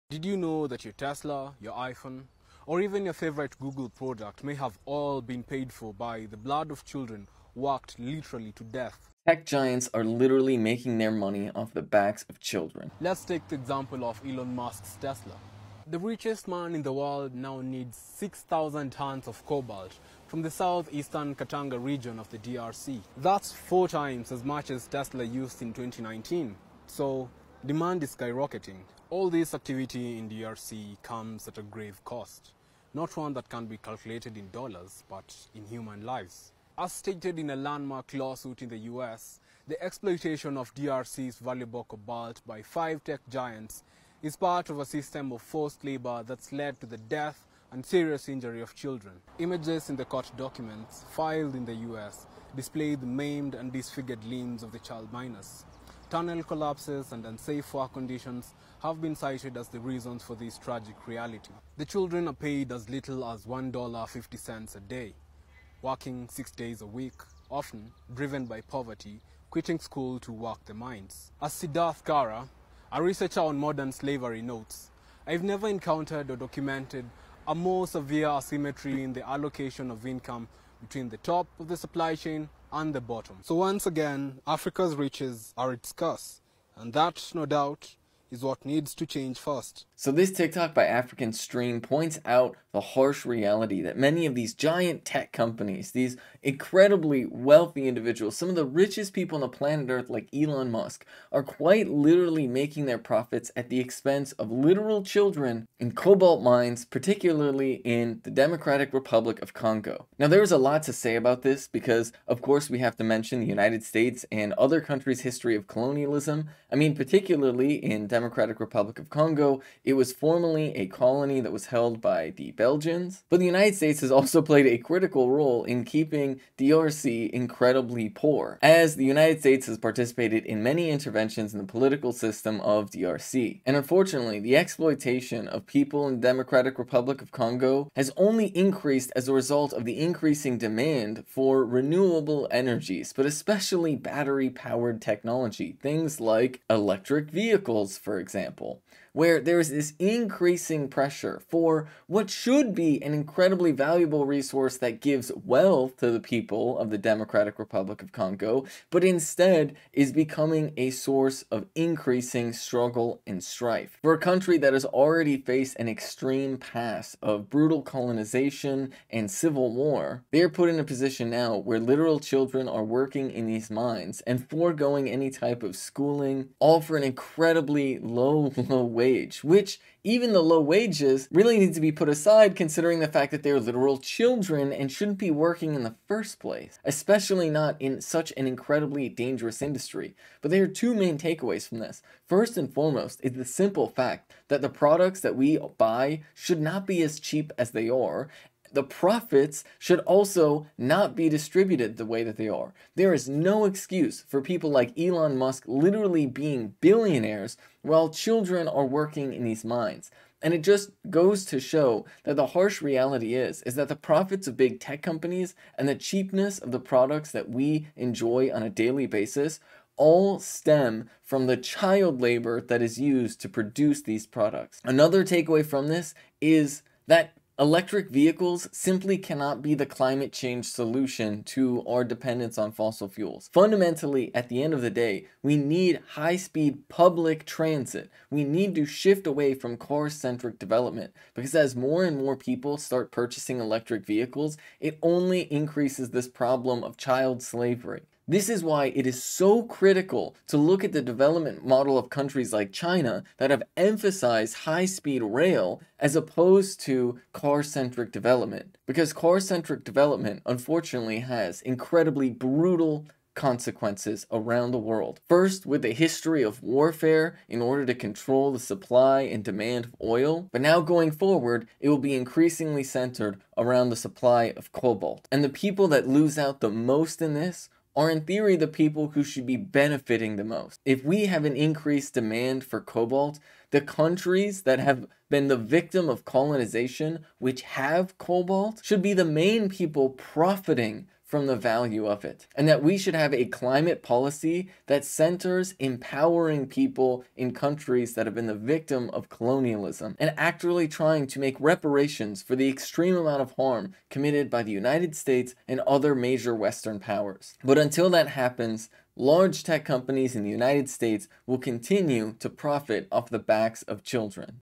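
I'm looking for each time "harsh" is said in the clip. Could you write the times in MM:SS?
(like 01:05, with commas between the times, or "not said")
01:32, 03:32.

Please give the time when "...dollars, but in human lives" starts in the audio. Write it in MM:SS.
00:34.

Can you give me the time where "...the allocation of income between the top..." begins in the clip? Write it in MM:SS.
01:19.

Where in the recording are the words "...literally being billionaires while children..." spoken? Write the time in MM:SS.
03:25.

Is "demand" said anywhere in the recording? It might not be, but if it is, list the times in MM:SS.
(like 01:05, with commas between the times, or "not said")
00:27, 02:20, 04:29, 04:42.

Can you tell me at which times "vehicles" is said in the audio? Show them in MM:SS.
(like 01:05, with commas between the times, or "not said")
02:27, 03:48, 04:04.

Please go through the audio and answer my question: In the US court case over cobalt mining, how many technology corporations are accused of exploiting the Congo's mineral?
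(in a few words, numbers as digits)
5.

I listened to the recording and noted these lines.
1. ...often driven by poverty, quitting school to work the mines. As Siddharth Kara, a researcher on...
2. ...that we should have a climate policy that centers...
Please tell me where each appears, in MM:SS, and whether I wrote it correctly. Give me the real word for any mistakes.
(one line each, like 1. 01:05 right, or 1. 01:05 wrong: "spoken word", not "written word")
1. 01:07 right
2. 04:52 right.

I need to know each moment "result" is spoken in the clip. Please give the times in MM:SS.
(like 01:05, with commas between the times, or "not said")
02:19.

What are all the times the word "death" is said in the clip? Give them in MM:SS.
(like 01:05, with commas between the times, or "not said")
00:08, 00:46.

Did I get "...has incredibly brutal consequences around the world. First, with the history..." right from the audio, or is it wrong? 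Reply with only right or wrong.
right.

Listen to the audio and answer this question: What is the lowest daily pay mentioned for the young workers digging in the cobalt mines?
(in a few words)
$1.50.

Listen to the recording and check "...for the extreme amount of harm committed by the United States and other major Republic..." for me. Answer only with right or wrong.
wrong.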